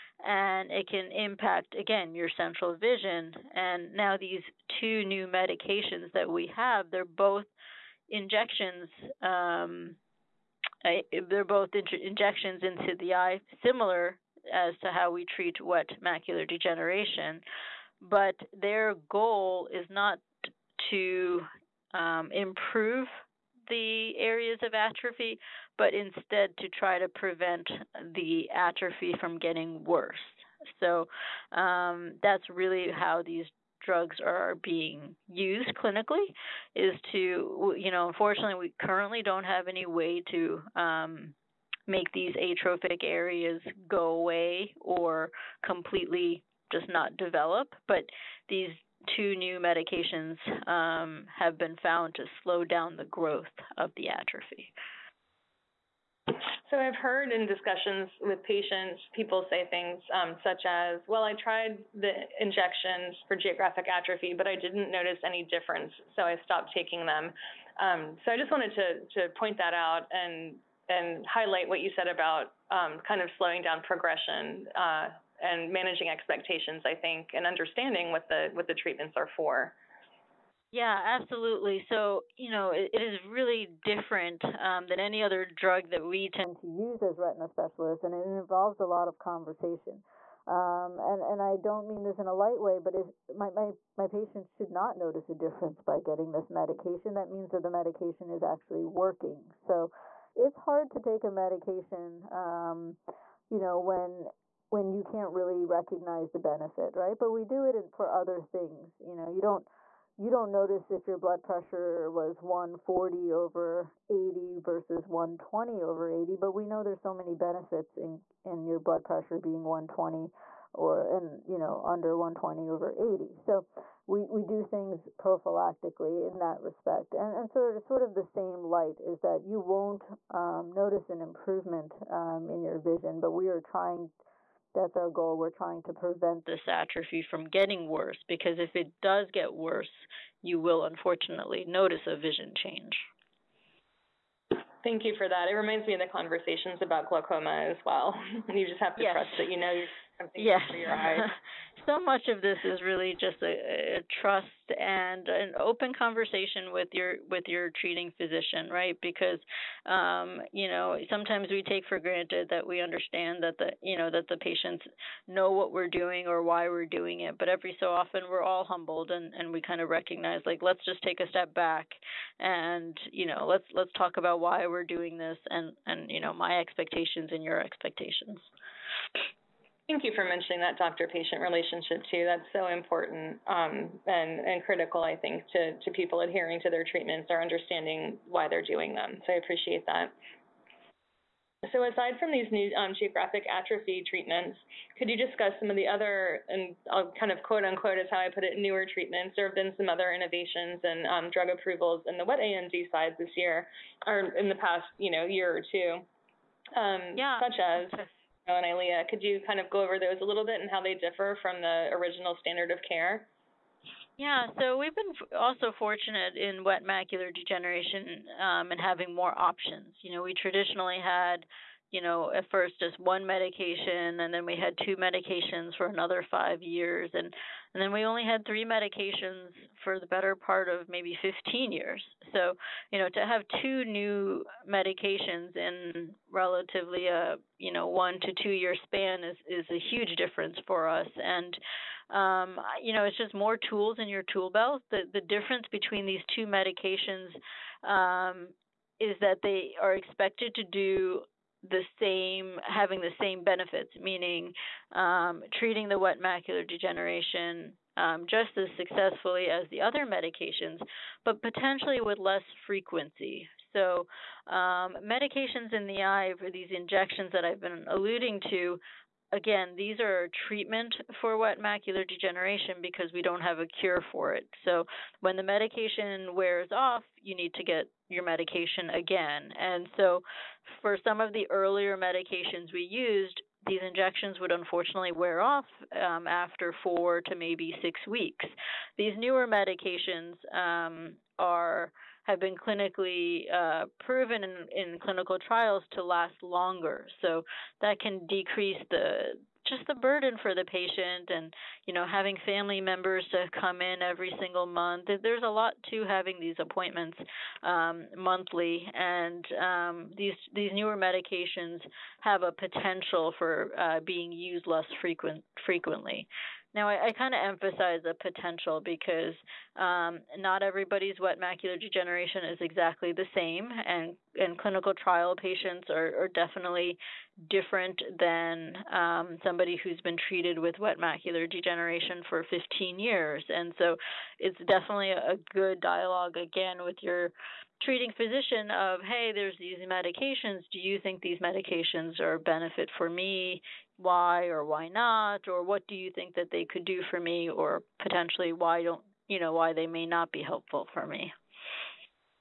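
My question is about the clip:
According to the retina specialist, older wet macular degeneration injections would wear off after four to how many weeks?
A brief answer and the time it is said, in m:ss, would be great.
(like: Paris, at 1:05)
6, at 4:47.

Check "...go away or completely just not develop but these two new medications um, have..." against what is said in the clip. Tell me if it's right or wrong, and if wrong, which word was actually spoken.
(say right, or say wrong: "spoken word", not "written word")
right.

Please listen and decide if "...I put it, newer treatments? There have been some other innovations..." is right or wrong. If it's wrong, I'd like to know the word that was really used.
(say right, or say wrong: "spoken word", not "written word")
right.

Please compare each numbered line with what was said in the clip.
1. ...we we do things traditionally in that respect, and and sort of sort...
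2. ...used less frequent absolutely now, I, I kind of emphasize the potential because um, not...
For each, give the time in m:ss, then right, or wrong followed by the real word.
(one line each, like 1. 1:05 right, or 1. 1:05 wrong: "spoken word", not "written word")
1. 2:04 wrong: "prophylactically", not "traditionally"
2. 5:14 wrong: "frequently", not "absolutely".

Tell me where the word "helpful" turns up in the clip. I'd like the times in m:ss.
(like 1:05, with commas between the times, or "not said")
5:50.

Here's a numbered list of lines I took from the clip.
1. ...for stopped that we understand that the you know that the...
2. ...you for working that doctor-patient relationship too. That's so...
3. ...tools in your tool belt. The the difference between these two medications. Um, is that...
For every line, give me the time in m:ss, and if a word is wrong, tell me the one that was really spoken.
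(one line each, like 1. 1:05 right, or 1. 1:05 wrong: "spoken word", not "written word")
1. 2:41 wrong: "granted", not "stopped"
2. 3:00 wrong: "mentioning", not "working"
3. 4:03 right.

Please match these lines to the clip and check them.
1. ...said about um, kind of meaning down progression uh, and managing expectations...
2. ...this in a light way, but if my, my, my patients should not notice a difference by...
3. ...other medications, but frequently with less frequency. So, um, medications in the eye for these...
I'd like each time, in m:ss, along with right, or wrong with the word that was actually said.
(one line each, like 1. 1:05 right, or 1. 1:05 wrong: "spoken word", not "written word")
1. 1:11 wrong: "slowing", not "meaning"
2. 1:32 right
3. 4:19 wrong: "potentially", not "frequently".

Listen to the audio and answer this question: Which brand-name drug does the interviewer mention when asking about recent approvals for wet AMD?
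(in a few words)
Eylea.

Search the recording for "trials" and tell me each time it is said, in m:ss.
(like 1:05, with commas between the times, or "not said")
4:55, 5:24.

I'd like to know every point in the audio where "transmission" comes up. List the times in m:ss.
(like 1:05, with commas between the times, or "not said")
not said.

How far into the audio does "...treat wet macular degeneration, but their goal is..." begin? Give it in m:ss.
0:15.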